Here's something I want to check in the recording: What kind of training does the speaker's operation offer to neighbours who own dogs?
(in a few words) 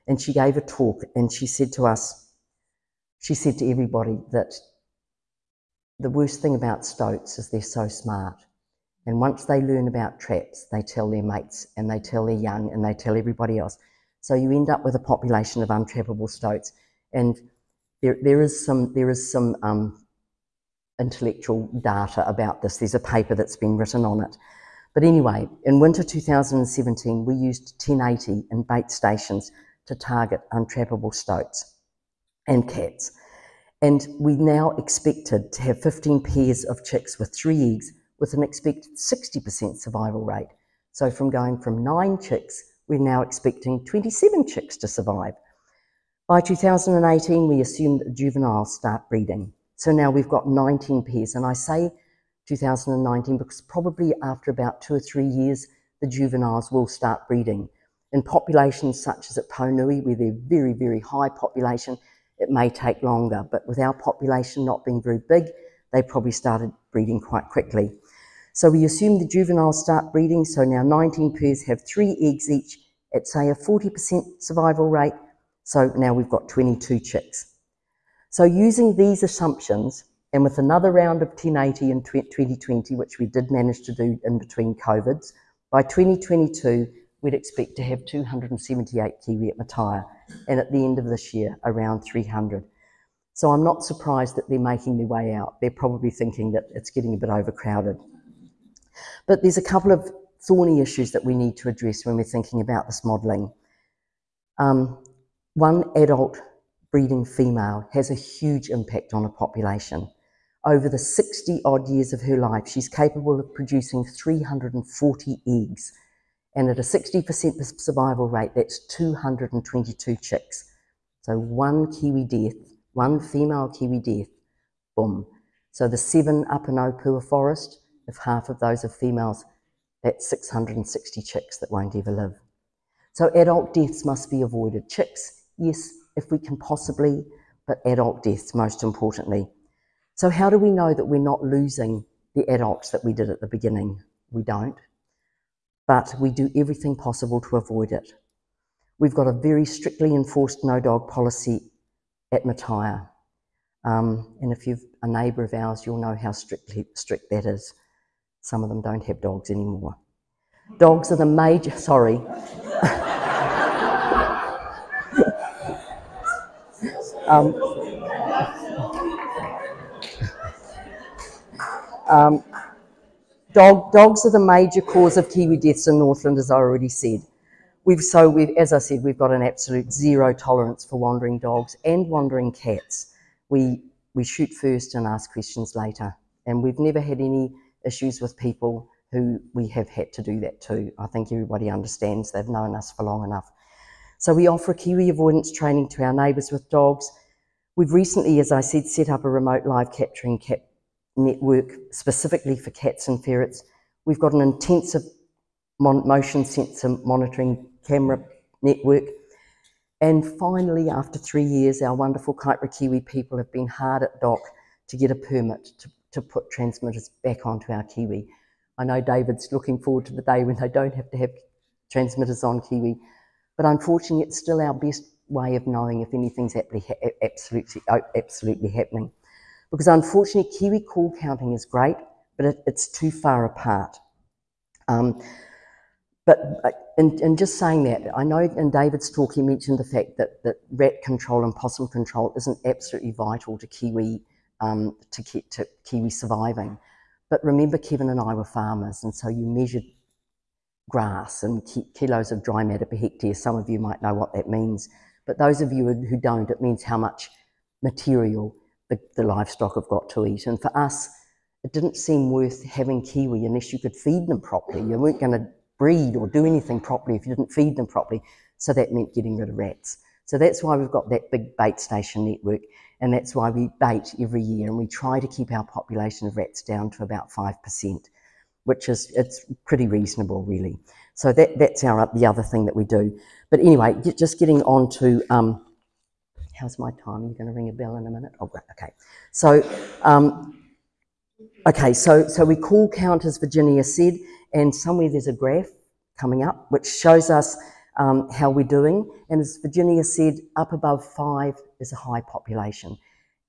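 Kiwi avoidance training.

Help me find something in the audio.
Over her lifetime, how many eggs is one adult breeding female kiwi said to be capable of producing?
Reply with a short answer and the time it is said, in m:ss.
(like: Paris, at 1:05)
340, at 1:54.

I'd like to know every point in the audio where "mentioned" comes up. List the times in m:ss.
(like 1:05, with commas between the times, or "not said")
3:59.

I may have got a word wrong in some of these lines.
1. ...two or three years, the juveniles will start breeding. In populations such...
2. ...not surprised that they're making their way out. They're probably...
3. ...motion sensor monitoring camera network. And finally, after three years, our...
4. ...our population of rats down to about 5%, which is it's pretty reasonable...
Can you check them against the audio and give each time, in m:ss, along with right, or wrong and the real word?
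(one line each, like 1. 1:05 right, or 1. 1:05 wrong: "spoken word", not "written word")
1. 0:54 right
2. 1:33 right
3. 3:25 right
4. 4:35 right.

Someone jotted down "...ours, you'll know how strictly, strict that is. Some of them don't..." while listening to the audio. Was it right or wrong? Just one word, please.
right.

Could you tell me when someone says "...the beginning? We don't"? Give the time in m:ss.
2:23.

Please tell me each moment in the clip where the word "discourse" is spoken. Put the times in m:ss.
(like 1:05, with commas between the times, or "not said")
not said.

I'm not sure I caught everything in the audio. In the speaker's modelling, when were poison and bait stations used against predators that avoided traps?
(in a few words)
winter 2017.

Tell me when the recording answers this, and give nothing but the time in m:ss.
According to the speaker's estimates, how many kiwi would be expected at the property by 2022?
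1:28.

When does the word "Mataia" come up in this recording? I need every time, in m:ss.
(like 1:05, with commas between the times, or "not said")
1:29, 2:32.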